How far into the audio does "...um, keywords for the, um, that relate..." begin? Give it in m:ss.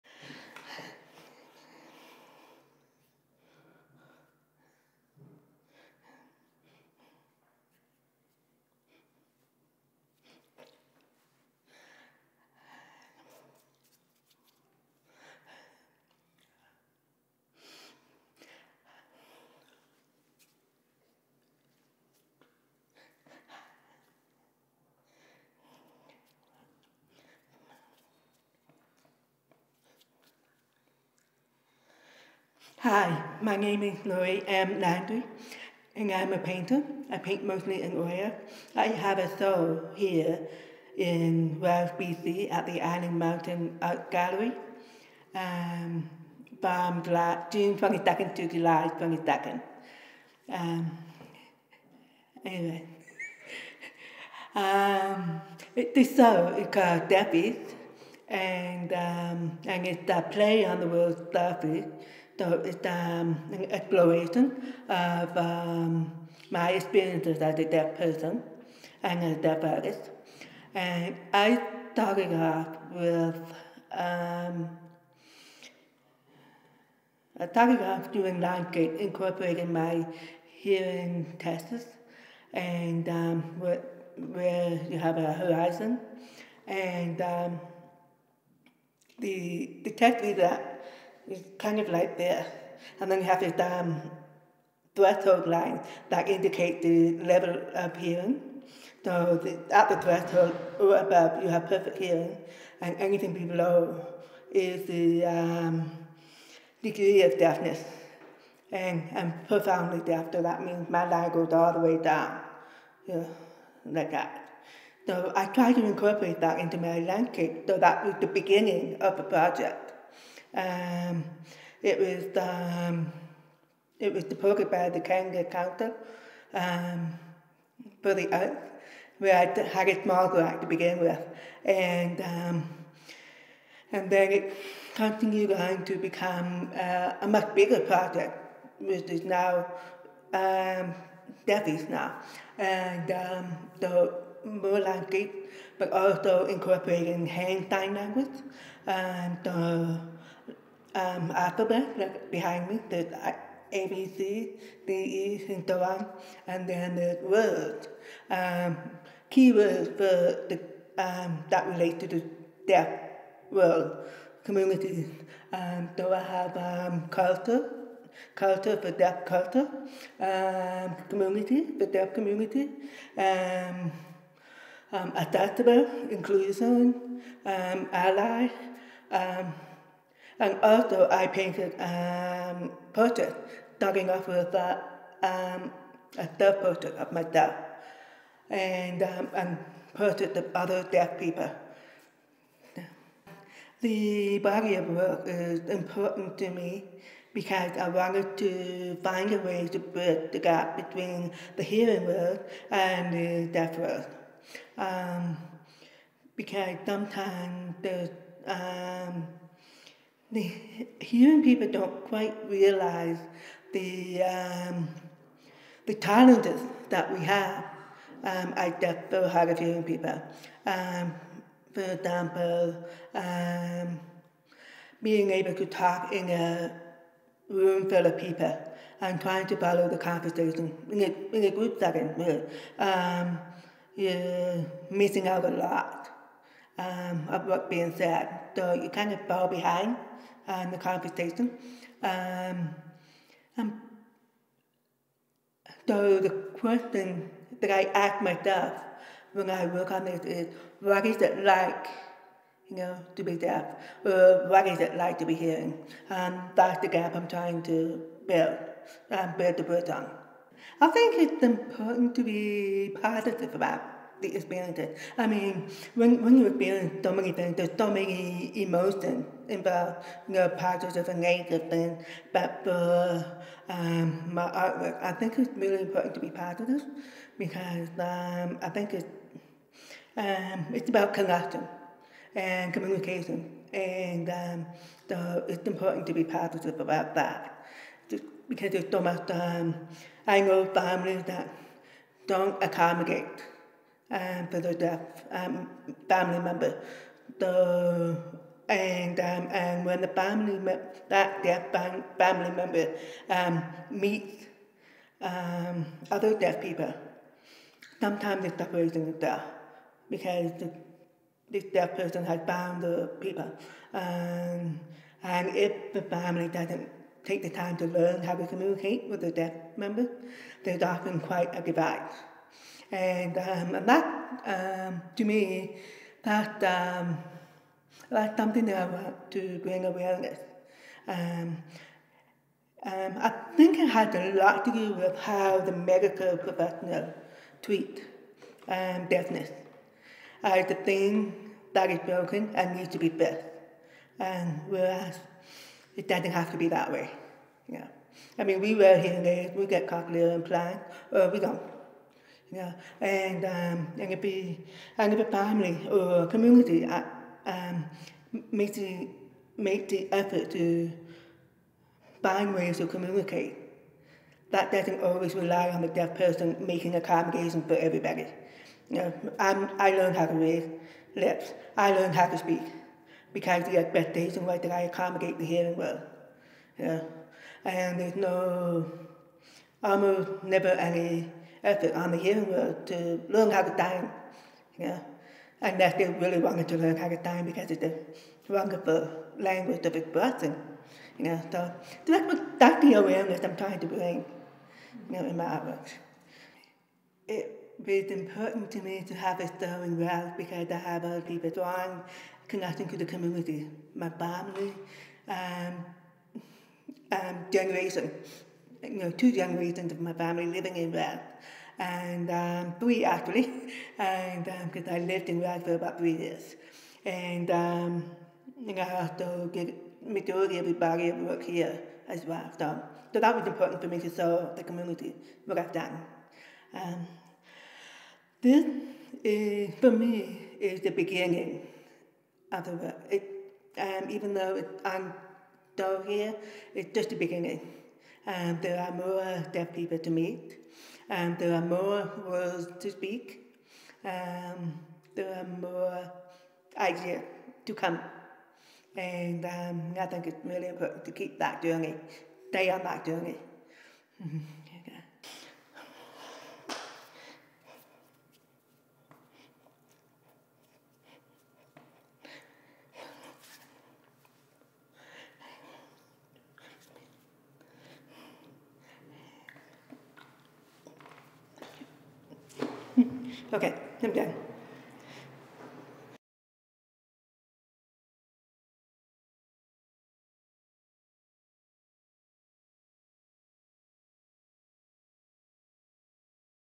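2:38.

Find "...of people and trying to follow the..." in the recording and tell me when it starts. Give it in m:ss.
3:48.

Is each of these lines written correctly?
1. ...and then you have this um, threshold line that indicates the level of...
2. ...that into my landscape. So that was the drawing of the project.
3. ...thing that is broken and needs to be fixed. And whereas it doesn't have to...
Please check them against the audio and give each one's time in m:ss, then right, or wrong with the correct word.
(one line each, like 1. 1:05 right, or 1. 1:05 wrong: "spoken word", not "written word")
1. 1:32 right
2. 1:56 wrong: "beginning", not "drawing"
3. 5:40 right.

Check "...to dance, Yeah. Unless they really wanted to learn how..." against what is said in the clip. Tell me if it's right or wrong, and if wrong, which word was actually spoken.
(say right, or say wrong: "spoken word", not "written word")
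right.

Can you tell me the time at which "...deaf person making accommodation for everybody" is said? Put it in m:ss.
6:05.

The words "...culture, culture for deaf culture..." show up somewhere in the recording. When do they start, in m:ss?
2:47.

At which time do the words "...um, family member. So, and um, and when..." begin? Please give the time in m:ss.
4:55.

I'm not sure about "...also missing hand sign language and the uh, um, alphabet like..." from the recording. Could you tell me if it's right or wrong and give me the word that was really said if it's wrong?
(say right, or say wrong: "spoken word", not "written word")
wrong: "incorporating", not "missing".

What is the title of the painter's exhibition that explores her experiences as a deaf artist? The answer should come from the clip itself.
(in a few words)
Deafies.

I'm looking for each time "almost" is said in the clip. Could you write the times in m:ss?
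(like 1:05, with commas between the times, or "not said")
6:19.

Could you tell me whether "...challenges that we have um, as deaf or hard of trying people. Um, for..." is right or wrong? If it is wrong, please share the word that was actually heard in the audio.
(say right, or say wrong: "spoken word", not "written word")
wrong: "hearing", not "trying".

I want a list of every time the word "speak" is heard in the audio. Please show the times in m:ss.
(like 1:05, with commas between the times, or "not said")
6:12, 7:22.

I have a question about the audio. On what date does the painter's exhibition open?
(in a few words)
June 22nd.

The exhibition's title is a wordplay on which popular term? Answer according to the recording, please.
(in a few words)
Selfies.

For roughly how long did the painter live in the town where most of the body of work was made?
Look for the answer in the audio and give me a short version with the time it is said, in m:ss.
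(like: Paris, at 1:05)
3 years, at 6:55.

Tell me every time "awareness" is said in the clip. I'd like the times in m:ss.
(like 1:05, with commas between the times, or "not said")
5:29, 6:32.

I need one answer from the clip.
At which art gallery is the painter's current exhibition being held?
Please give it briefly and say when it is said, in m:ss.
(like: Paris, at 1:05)
Island Mountain Art Gallery, at 0:42.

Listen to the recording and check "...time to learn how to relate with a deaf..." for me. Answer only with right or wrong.
wrong.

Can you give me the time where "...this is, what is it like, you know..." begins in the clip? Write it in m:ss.
4:10.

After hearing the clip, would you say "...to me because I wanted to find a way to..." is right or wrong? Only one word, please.
right.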